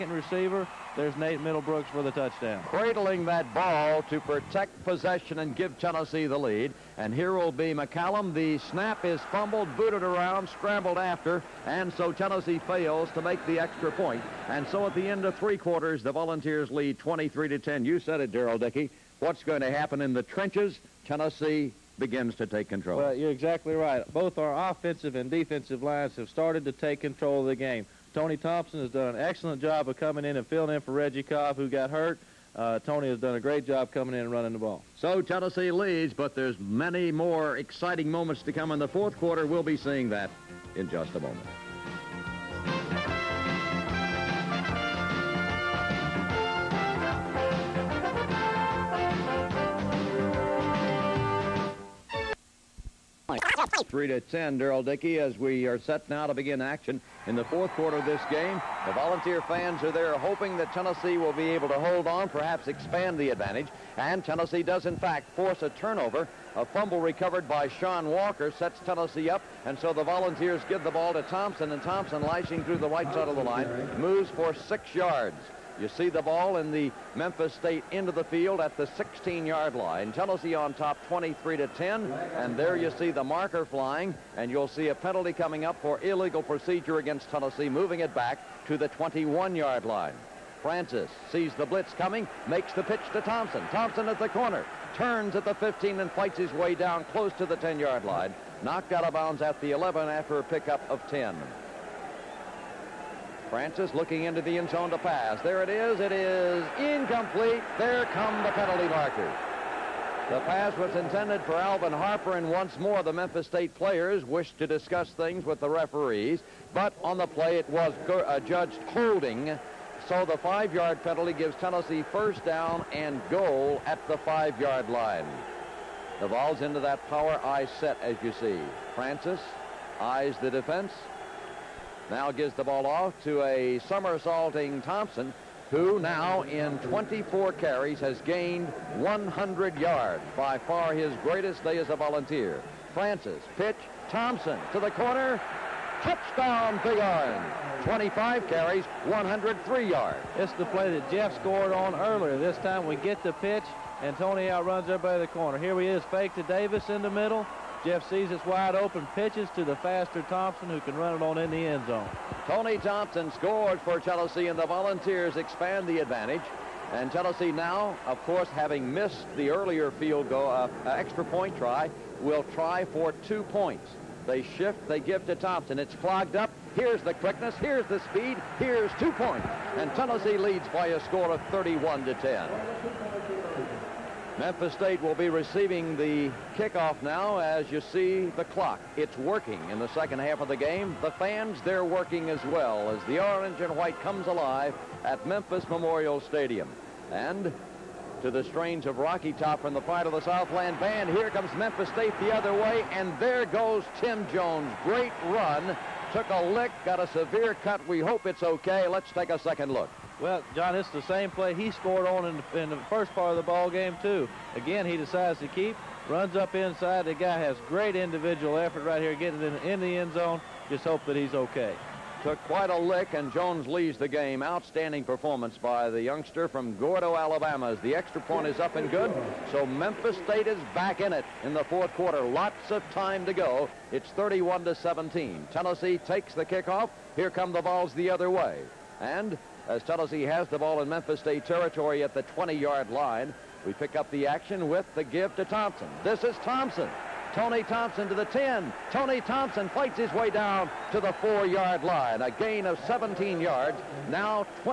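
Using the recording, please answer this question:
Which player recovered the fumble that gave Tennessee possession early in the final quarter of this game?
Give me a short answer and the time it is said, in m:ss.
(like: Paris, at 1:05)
Sean Walker, at 1:07.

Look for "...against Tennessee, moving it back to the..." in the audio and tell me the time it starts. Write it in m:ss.
1:26.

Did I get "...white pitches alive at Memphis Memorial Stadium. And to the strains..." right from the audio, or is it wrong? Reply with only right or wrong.
wrong.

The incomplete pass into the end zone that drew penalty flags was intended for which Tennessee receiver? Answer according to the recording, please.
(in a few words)
Alvin Harper.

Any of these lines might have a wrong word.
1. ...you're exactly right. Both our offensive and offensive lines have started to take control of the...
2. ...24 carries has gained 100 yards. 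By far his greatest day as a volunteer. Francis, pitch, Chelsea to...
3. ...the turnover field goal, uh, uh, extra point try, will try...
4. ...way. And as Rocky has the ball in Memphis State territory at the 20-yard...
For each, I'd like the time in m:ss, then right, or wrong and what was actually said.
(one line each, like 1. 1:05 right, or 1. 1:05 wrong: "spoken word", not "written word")
1. 0:23 wrong: "defensive", not "offensive"
2. 2:16 wrong: "Thompson", not "Chelsea"
3. 2:49 wrong: "earlier", not "turnover"
4. 3:58 wrong: "Tennessee", not "Rocky".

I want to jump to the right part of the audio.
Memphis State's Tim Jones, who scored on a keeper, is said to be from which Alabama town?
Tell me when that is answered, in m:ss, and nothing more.
3:46.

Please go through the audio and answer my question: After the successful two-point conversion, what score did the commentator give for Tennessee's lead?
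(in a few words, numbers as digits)
31 to 10.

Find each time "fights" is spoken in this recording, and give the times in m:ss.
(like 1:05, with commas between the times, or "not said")
1:36, 4:09.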